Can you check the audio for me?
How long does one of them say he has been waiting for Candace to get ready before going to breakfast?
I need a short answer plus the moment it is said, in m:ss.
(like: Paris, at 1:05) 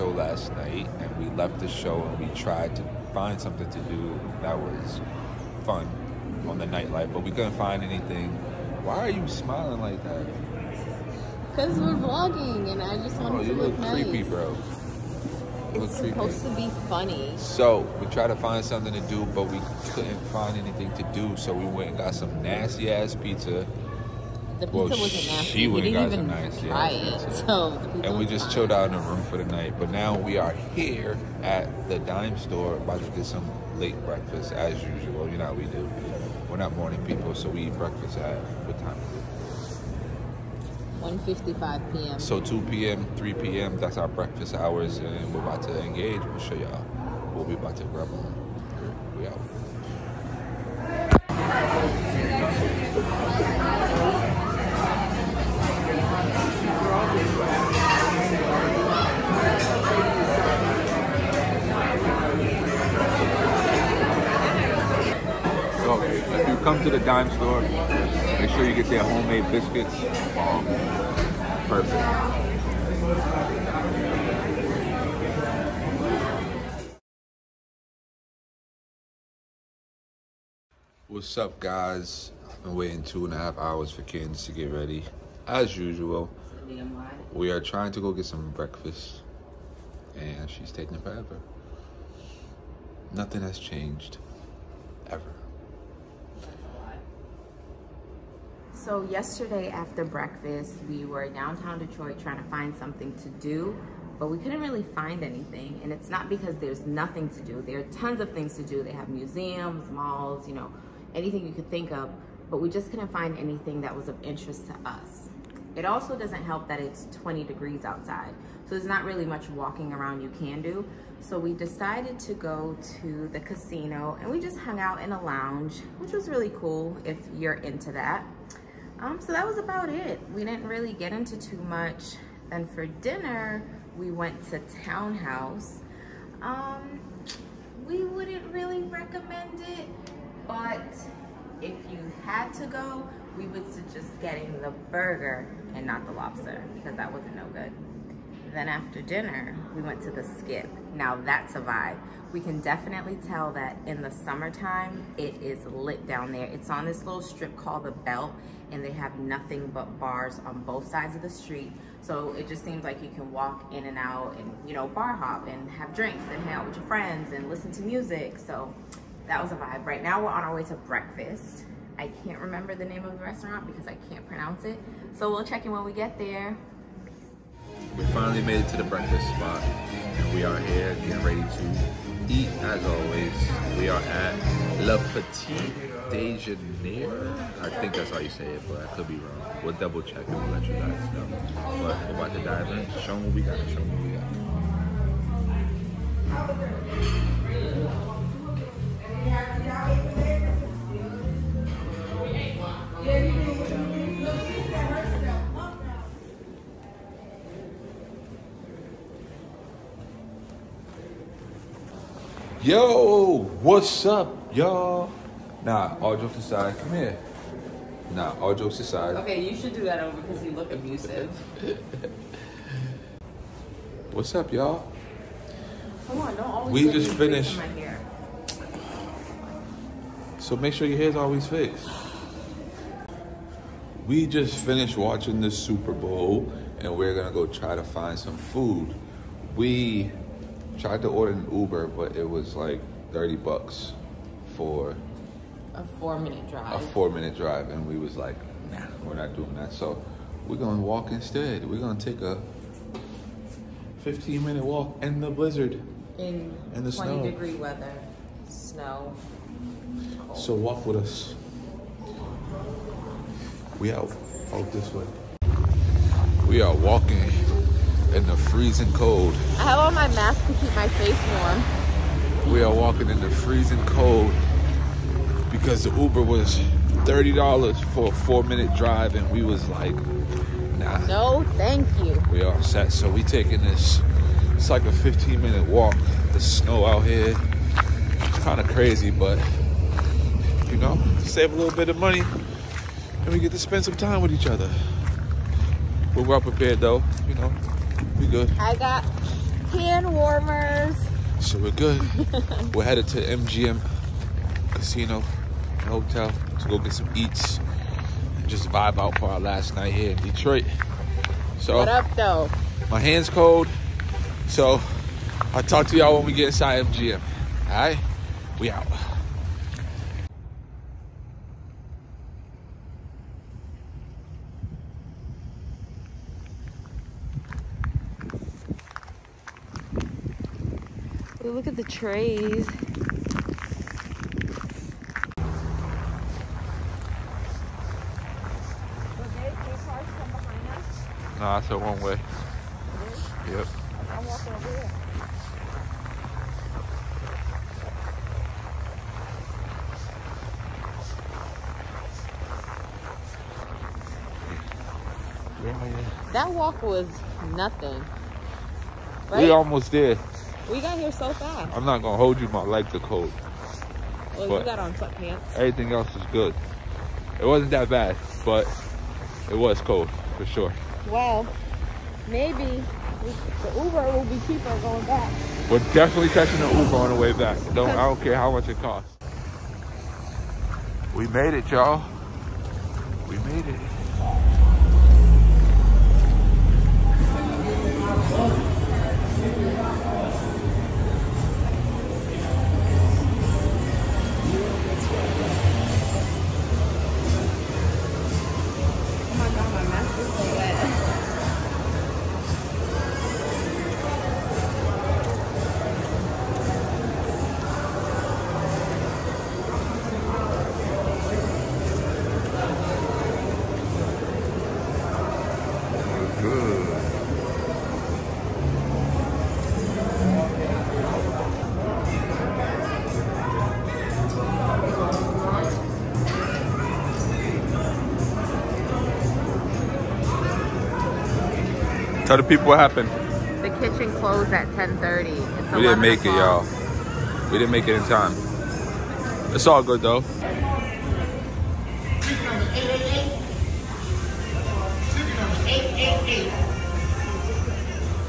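Two and a half hours, at 1:23.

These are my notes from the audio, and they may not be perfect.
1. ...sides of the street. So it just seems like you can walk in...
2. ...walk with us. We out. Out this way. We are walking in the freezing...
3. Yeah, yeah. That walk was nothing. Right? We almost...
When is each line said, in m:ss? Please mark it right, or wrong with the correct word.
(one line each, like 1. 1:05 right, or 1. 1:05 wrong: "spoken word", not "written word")
1. 2:40 right
2. 4:20 right
3. 5:55 right.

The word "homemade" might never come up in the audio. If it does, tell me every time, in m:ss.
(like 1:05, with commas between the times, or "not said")
1:09.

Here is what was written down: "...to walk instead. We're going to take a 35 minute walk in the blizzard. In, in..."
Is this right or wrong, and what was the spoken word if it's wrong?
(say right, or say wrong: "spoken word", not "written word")
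wrong: "15", not "35".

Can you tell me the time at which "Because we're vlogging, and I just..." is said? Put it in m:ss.
0:11.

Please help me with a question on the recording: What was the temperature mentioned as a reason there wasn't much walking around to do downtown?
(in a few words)
20 degrees.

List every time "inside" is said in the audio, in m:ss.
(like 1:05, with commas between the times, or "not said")
5:16.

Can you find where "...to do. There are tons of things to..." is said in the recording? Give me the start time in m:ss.
1:47.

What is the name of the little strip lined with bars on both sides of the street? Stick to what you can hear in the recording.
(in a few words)
The Belt.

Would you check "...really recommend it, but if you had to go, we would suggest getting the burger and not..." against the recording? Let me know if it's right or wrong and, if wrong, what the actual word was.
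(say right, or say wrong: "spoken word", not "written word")
right.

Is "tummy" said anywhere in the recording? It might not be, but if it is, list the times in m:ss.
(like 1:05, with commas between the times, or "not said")
not said.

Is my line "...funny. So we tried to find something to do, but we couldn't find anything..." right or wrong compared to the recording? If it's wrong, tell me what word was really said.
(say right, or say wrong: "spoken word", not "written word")
right.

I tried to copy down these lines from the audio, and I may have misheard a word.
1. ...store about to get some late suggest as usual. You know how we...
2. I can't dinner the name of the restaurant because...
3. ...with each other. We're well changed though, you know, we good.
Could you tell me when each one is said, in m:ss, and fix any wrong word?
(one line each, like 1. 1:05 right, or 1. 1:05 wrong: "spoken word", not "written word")
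1. 0:32 wrong: "breakfast", not "suggest"
2. 2:51 wrong: "remember", not "dinner"
3. 4:54 wrong: "prepared", not "changed".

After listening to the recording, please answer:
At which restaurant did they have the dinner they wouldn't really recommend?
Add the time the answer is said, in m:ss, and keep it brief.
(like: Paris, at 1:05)
Townhouse, at 2:14.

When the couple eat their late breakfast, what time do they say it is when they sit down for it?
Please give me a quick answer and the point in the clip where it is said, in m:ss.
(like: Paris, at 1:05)
1:55 p.m., at 0:41.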